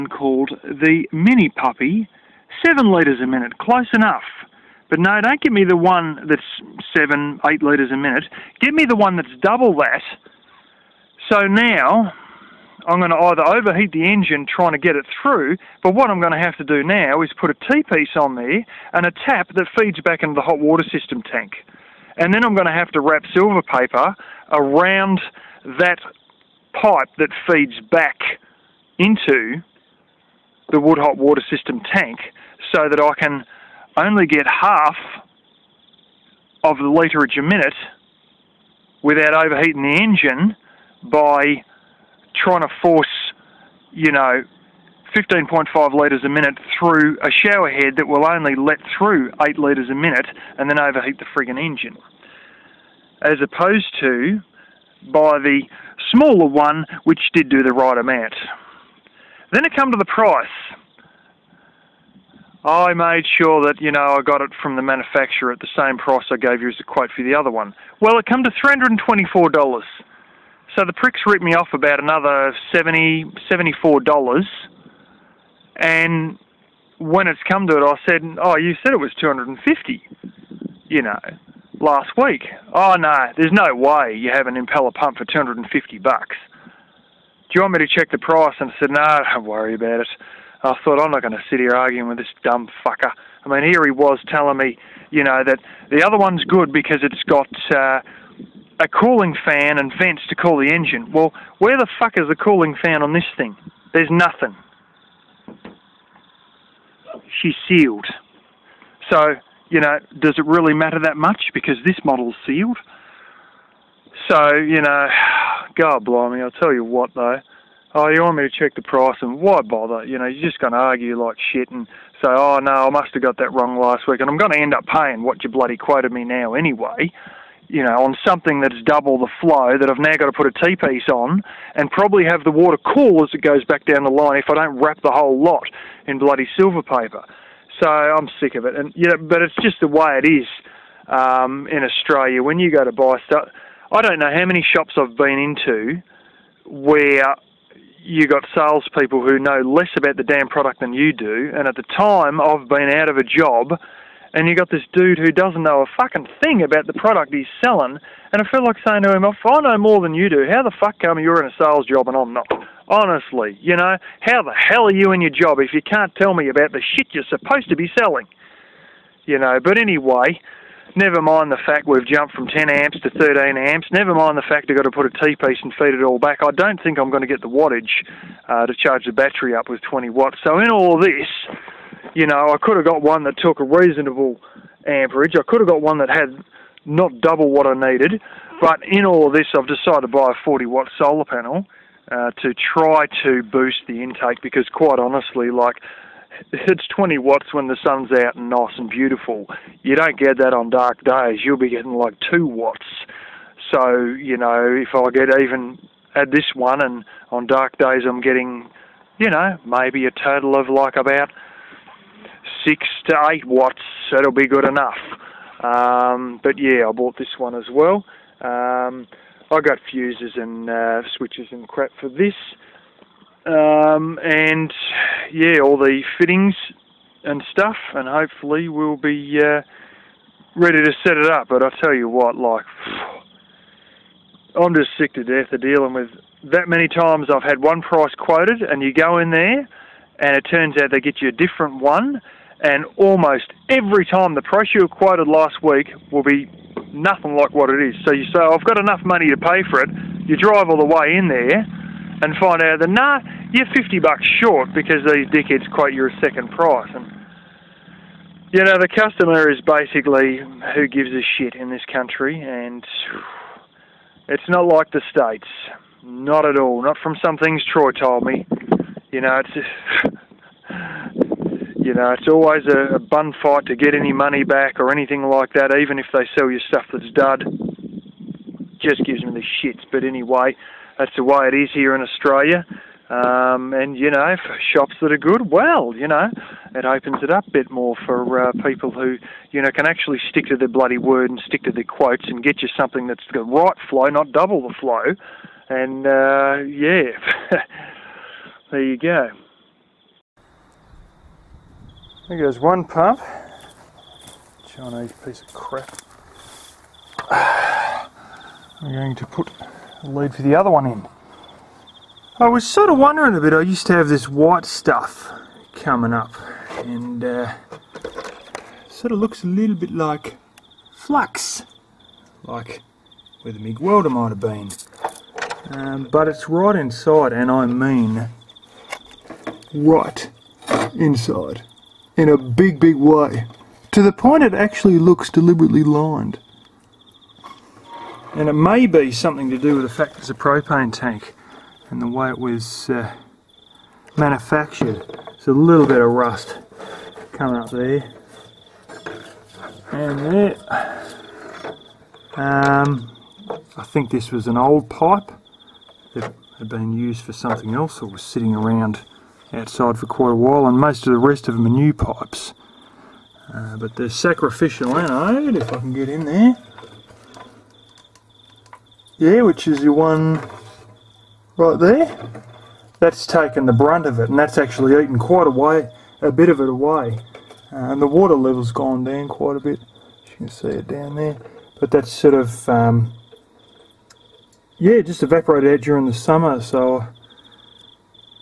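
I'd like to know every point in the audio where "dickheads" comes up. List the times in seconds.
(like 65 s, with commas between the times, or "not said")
255 s.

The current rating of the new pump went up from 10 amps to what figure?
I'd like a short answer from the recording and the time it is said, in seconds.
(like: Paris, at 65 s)
13 amps, at 173 s.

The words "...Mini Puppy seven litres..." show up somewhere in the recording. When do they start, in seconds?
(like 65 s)
1 s.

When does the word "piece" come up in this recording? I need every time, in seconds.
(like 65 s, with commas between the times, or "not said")
17 s, 130 s, 175 s, 305 s.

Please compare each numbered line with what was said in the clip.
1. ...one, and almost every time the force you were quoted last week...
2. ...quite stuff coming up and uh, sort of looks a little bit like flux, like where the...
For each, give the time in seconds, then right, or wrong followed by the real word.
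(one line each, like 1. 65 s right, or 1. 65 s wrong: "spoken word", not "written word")
1. 241 s wrong: "price", not "force"
2. 314 s wrong: "white", not "quite".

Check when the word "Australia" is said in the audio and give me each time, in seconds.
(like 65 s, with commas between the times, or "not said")
141 s, 282 s.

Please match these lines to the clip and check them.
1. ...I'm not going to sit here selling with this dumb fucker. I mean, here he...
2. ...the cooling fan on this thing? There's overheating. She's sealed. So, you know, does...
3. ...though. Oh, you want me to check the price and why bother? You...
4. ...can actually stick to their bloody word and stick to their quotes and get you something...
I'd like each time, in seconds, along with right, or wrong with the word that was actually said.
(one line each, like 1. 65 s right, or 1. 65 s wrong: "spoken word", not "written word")
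1. 91 s wrong: "arguing", not "selling"
2. 102 s wrong: "nothing", not "overheating"
3. 117 s right
4. 289 s right.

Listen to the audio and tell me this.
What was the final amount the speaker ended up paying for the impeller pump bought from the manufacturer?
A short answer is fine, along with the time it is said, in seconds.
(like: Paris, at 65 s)
$324, at 68 s.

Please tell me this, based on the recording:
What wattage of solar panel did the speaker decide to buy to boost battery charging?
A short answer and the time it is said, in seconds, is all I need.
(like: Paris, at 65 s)
40 watt, at 190 s.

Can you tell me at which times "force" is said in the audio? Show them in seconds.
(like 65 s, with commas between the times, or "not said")
42 s.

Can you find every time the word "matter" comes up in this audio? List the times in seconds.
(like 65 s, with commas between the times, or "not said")
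110 s.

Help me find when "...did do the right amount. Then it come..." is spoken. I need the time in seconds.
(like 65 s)
57 s.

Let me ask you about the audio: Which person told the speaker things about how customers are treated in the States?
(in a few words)
Troy.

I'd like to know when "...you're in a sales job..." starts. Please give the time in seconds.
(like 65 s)
161 s.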